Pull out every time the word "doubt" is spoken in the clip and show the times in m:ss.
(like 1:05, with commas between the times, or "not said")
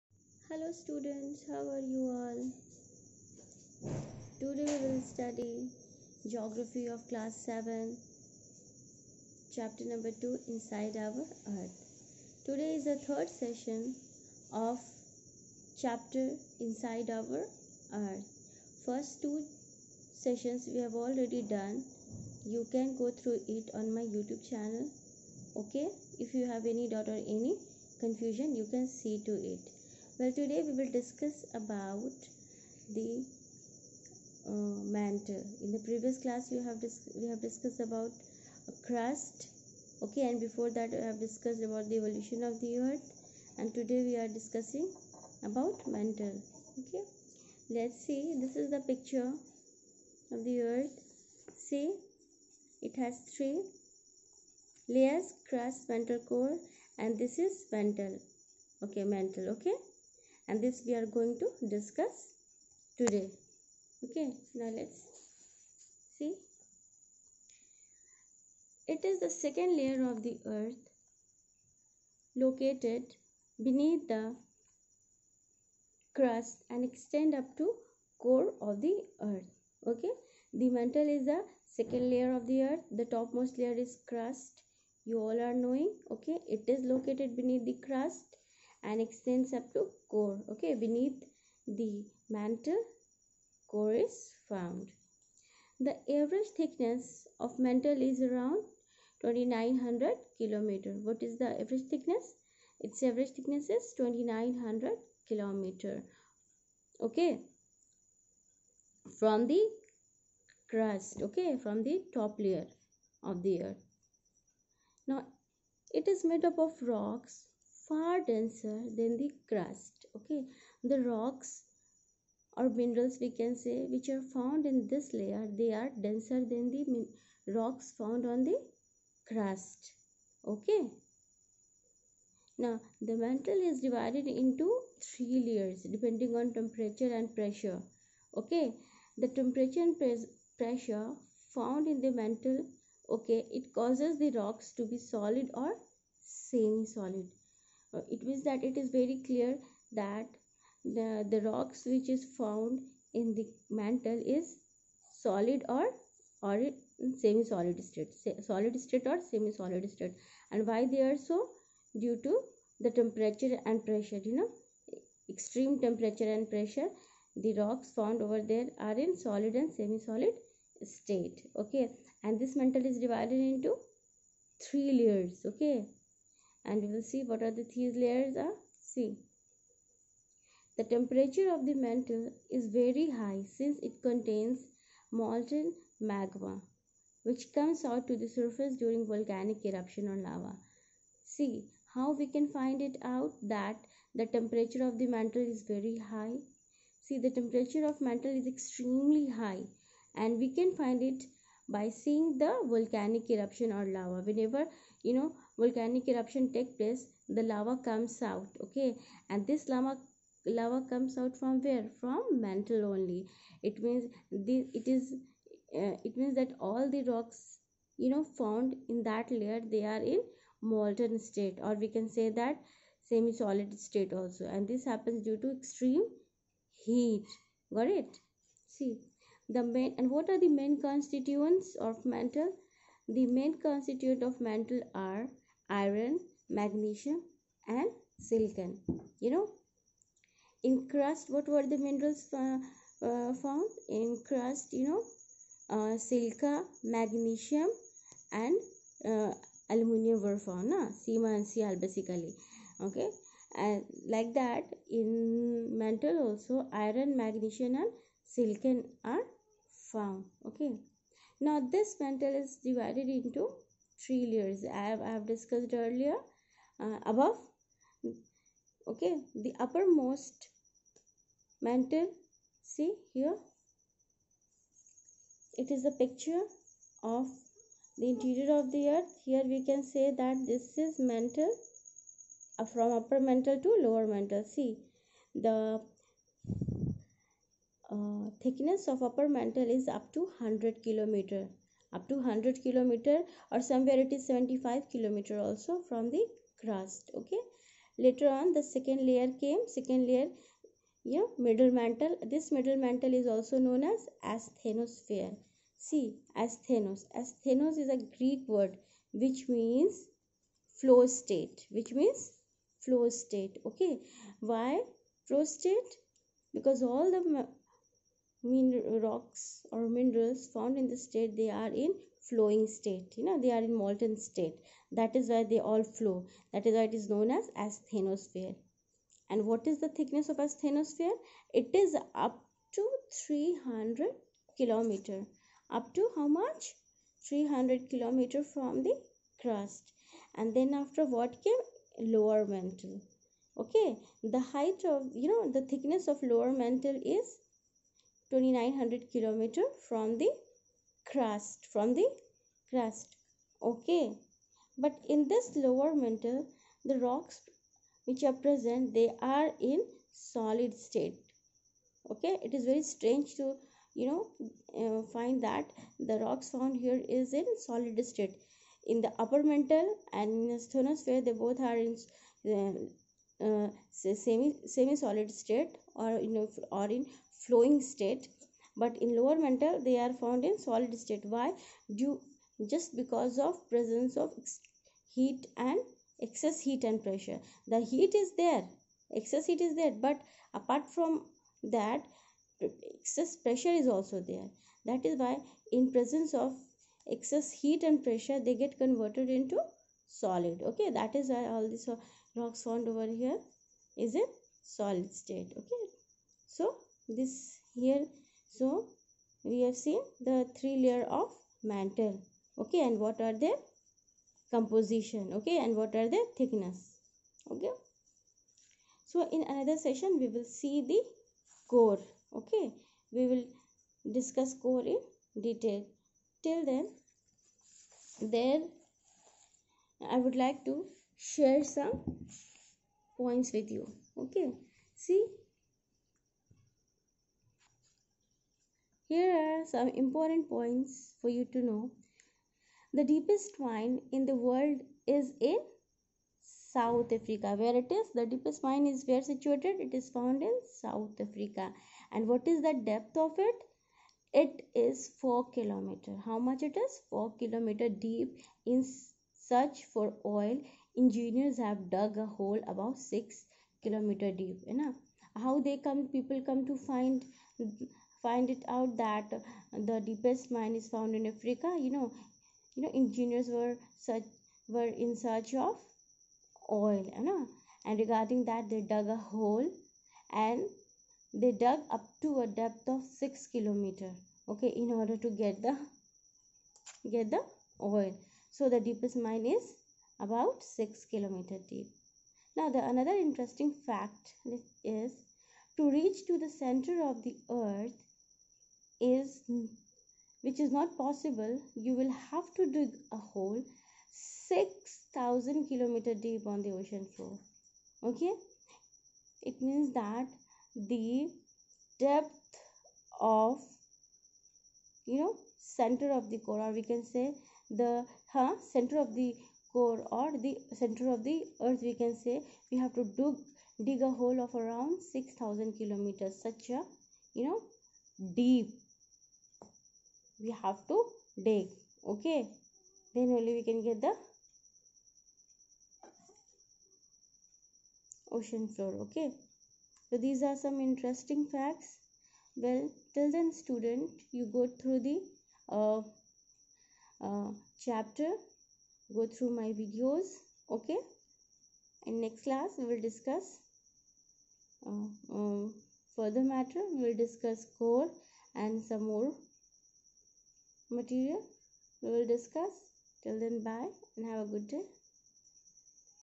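0:26.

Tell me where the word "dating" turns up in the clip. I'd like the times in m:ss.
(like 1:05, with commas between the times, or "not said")
not said.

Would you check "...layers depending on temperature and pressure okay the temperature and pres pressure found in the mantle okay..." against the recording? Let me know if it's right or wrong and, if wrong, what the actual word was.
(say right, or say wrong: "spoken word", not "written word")
right.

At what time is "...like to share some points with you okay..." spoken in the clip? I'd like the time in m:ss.
7:10.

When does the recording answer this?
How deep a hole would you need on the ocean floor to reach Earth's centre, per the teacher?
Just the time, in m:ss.
8:24.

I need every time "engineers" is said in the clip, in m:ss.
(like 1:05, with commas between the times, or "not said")
7:40, 7:52.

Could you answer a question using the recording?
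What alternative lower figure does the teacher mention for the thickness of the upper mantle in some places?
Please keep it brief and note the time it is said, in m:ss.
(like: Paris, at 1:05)
75 kilometers, at 4:54.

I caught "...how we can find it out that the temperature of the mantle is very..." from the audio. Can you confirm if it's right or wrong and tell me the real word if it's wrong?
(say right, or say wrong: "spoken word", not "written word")
right.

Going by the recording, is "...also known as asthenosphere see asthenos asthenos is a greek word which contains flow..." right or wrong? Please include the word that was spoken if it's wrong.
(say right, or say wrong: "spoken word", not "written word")
wrong: "means", not "contains".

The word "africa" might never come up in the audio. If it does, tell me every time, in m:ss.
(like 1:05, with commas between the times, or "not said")
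7:27, 7:31, 7:51.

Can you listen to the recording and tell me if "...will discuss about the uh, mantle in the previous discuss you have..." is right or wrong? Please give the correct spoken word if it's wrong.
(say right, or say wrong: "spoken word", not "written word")
wrong: "class", not "discuss".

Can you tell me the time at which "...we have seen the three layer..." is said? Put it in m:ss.
6:49.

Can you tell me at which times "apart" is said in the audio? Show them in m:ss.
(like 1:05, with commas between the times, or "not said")
6:30.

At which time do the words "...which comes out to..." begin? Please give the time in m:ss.
3:07.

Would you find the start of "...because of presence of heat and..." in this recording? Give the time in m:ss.
6:22.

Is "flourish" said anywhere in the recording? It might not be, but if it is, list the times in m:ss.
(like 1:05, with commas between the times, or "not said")
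not said.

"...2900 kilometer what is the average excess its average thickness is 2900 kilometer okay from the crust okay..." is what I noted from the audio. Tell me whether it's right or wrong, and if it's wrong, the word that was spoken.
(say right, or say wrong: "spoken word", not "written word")
wrong: "thickness", not "excess".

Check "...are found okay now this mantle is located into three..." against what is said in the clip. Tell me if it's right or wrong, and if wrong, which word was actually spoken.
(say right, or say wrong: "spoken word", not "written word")
wrong: "divided", not "located".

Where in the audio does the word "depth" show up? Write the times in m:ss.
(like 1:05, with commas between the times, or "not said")
7:32, 8:02, 8:31.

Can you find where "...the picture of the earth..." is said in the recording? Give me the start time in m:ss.
0:48.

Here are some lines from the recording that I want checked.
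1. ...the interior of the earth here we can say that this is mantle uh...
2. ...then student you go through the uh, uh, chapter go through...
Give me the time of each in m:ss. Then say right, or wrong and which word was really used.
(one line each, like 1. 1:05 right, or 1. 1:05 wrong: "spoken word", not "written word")
1. 4:37 right
2. 9:03 right.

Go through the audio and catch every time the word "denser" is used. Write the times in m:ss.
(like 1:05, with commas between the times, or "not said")
1:58, 2:06.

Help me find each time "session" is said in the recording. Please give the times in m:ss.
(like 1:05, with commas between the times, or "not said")
0:13, 0:20, 6:59.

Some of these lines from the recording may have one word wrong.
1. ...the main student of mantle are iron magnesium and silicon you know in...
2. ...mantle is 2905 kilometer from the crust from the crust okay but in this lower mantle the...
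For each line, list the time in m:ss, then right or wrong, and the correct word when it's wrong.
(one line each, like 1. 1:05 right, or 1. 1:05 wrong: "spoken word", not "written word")
1. 3:53 wrong: "constituent", not "student"
2. 5:46 wrong: "2900", not "2905".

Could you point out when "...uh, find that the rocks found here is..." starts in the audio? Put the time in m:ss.
6:04.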